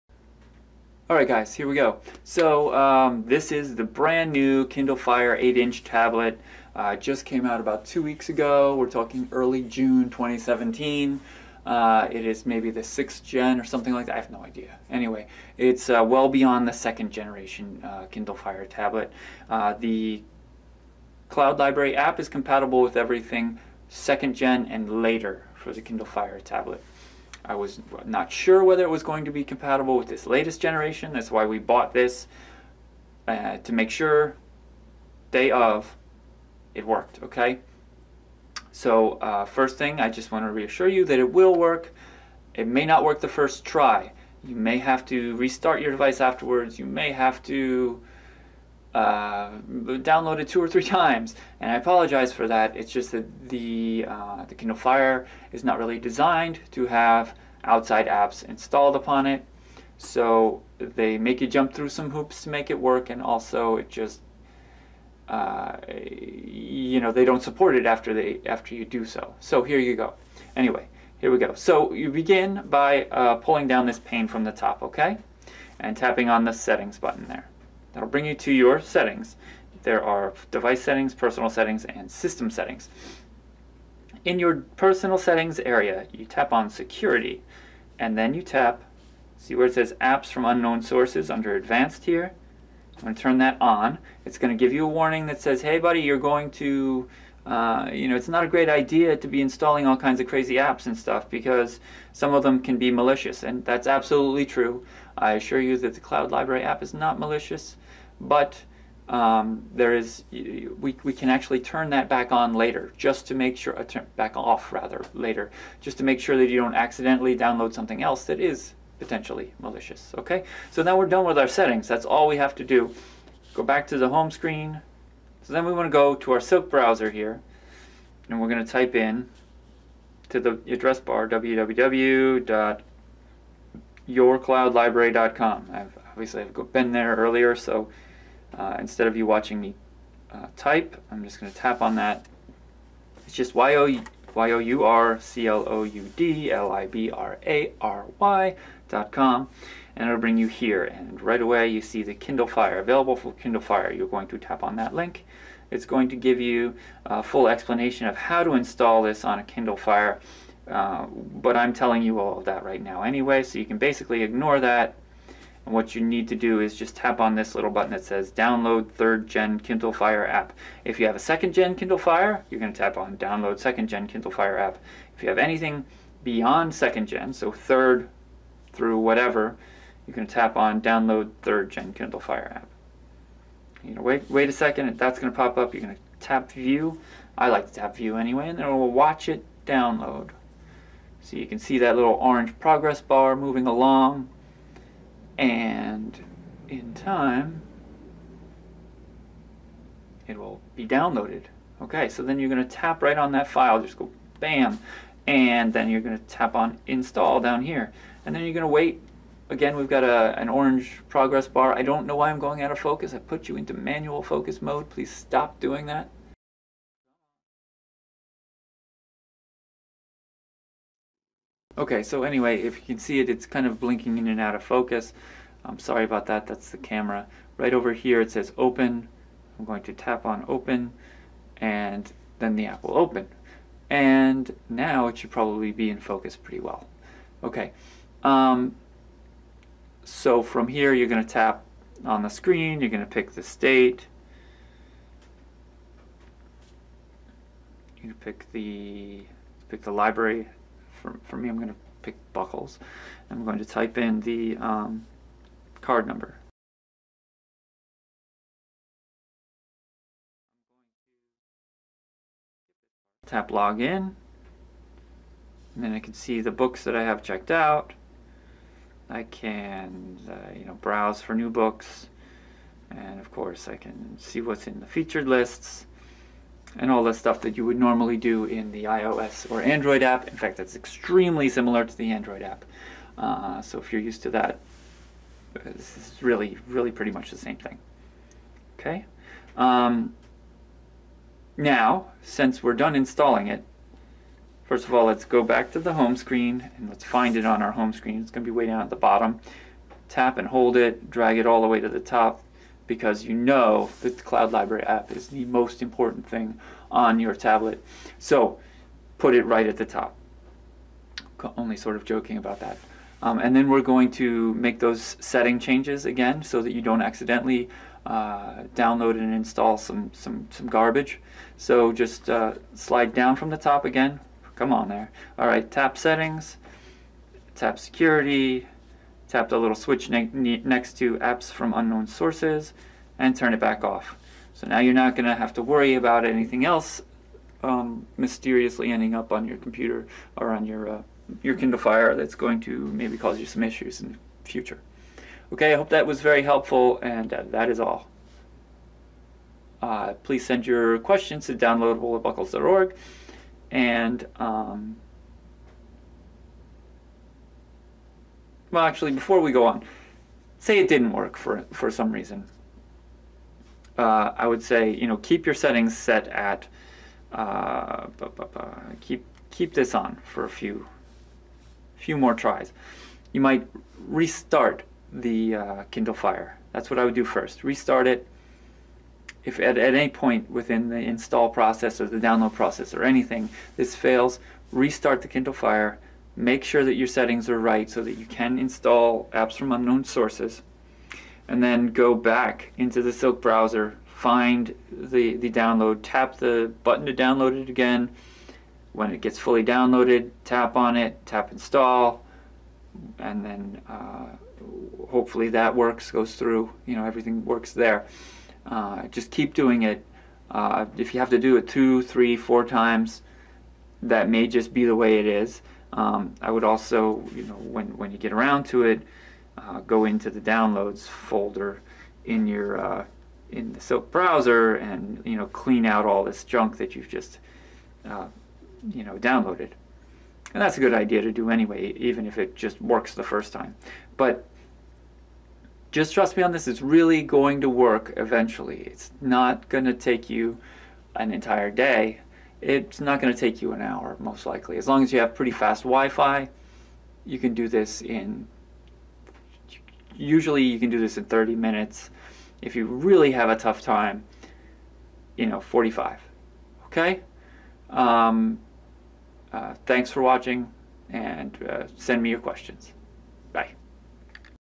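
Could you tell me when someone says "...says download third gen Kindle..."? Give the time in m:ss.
2:48.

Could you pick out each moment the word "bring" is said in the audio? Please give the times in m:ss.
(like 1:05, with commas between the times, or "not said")
1:18, 2:30.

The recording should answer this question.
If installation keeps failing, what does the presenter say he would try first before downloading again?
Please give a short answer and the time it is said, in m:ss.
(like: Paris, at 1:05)
Restart it, at 6:17.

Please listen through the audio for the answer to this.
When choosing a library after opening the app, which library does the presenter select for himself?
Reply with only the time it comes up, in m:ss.
4:12.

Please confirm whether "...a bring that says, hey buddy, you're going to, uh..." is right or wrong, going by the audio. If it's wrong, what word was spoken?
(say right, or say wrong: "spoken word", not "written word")
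wrong: "warning", not "bring".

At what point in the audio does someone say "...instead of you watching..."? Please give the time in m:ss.
2:18.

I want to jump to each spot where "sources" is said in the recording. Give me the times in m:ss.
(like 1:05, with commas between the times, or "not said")
1:30, 5:32, 6:30.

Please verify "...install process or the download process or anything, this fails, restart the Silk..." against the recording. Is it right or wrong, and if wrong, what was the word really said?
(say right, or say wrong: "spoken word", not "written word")
wrong: "Kindle", not "Silk".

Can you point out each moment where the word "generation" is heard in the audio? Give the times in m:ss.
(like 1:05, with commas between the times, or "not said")
0:17, 0:30.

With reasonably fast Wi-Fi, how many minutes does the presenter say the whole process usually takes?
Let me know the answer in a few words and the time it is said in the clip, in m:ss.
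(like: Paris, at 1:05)
30 minutes, at 7:31.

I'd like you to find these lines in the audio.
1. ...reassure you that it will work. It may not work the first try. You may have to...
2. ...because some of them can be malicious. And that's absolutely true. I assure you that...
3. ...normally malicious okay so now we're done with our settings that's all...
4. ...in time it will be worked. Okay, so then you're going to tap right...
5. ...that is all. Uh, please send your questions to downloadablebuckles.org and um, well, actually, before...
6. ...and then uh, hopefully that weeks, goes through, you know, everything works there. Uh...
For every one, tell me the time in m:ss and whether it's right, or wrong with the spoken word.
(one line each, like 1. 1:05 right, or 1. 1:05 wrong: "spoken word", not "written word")
1. 0:40 right
2. 1:41 right
3. 1:58 wrong: "potentially", not "normally"
4. 3:16 wrong: "downloaded", not "worked"
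5. 5:47 right
6. 6:43 wrong: "works", not "weeks".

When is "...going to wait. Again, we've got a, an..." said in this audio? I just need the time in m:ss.
3:28.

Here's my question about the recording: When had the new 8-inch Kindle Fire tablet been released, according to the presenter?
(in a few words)
Early June 2017.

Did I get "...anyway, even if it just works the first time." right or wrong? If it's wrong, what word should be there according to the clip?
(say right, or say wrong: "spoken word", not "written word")
right.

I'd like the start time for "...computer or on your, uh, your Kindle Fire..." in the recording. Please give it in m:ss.
5:39.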